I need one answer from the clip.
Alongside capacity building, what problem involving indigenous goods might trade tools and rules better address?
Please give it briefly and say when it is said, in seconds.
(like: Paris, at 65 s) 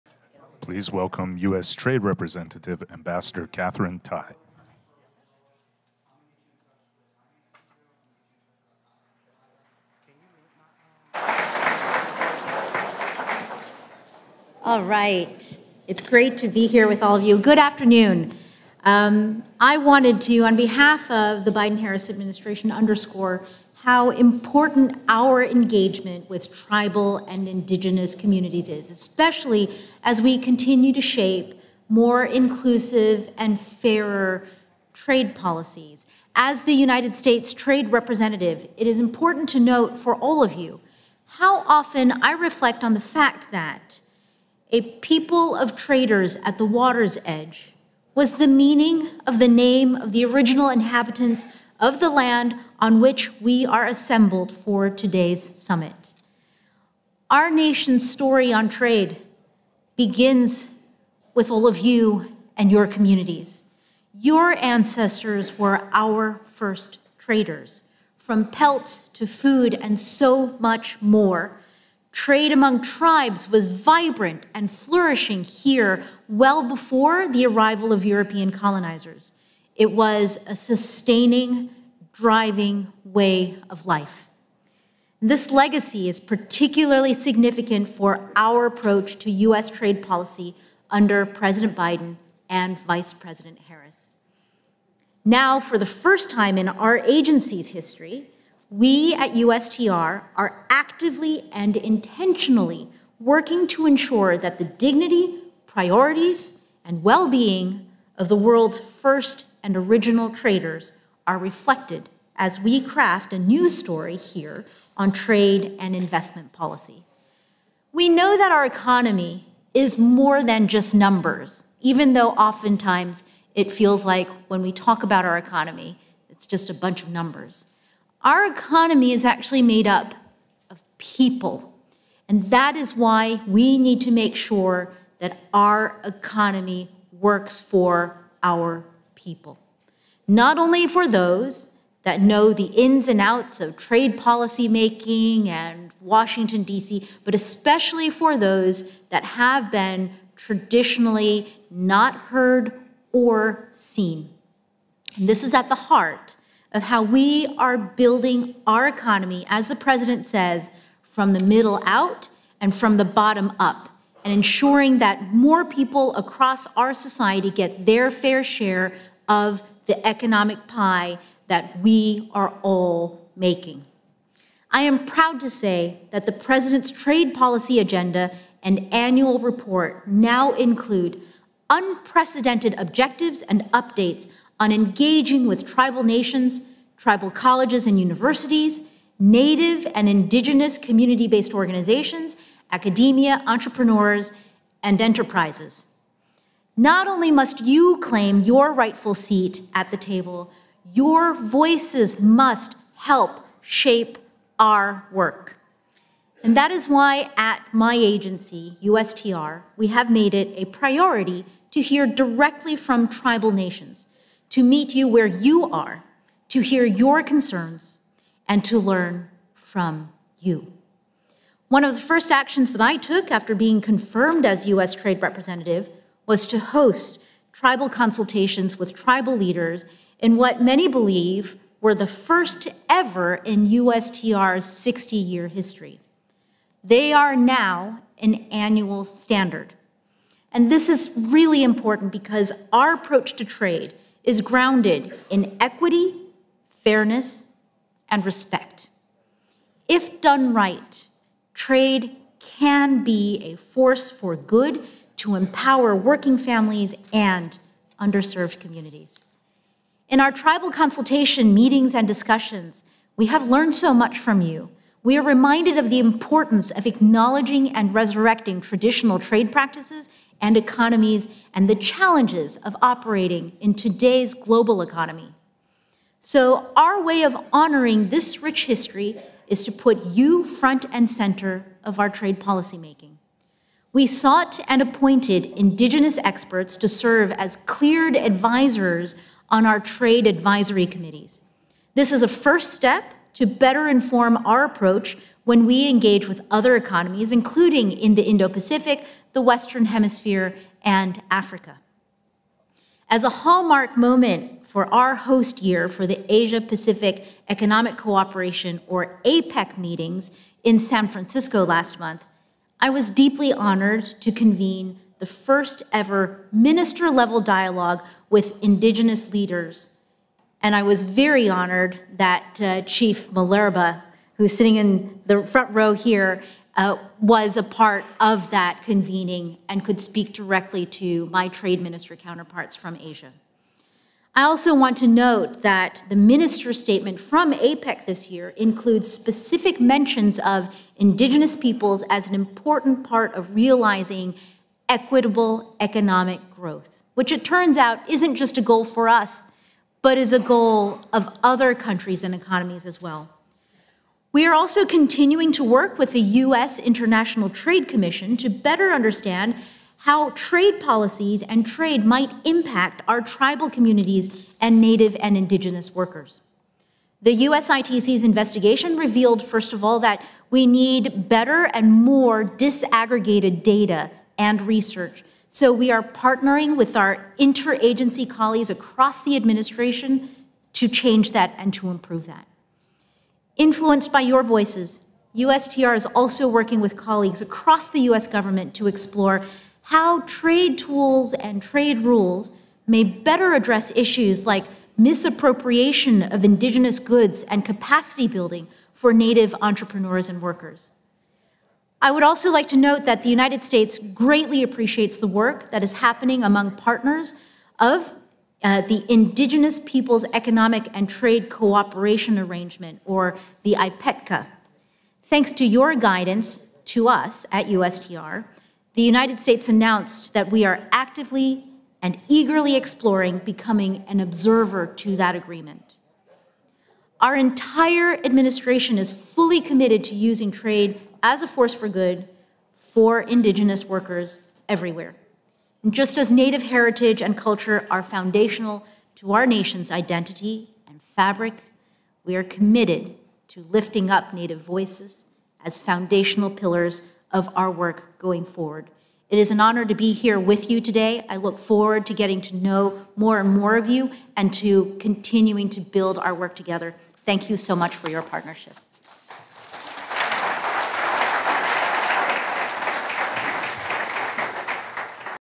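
Misappropriation, at 394 s.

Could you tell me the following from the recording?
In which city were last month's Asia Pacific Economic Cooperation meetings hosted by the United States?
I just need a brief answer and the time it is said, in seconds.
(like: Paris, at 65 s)
San Francisco, at 310 s.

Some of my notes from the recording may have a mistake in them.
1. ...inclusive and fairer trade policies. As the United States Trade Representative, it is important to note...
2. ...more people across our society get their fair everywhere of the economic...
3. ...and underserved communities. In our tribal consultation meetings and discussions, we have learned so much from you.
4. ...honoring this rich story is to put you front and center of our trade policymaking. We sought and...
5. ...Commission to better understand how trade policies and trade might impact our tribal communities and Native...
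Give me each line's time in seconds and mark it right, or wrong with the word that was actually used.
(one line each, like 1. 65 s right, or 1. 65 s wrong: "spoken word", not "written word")
1. 32 s right
2. 165 s wrong: "share", not "everywhere"
3. 257 s right
4. 277 s wrong: "history", not "story"
5. 357 s right.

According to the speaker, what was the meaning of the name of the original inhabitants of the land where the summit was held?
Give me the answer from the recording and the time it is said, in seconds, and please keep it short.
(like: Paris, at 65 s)
A people of traders at the water's edge, at 44 s.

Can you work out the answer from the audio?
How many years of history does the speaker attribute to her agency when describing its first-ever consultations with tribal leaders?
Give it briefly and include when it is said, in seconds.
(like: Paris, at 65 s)
60, at 234 s.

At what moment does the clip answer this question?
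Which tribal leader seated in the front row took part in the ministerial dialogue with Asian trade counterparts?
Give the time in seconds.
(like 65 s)
322 s.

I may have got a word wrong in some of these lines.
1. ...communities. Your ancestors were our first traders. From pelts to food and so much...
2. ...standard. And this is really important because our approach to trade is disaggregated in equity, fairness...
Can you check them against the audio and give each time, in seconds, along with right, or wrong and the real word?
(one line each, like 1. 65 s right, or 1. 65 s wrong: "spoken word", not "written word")
1. 62 s right
2. 239 s wrong: "grounded", not "disaggregated".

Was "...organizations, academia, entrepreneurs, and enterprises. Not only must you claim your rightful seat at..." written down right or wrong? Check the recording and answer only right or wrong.
right.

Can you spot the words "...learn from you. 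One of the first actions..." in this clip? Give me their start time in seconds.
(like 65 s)
218 s.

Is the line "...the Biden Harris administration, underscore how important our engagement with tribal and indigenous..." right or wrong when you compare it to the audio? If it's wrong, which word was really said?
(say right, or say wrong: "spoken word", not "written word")
right.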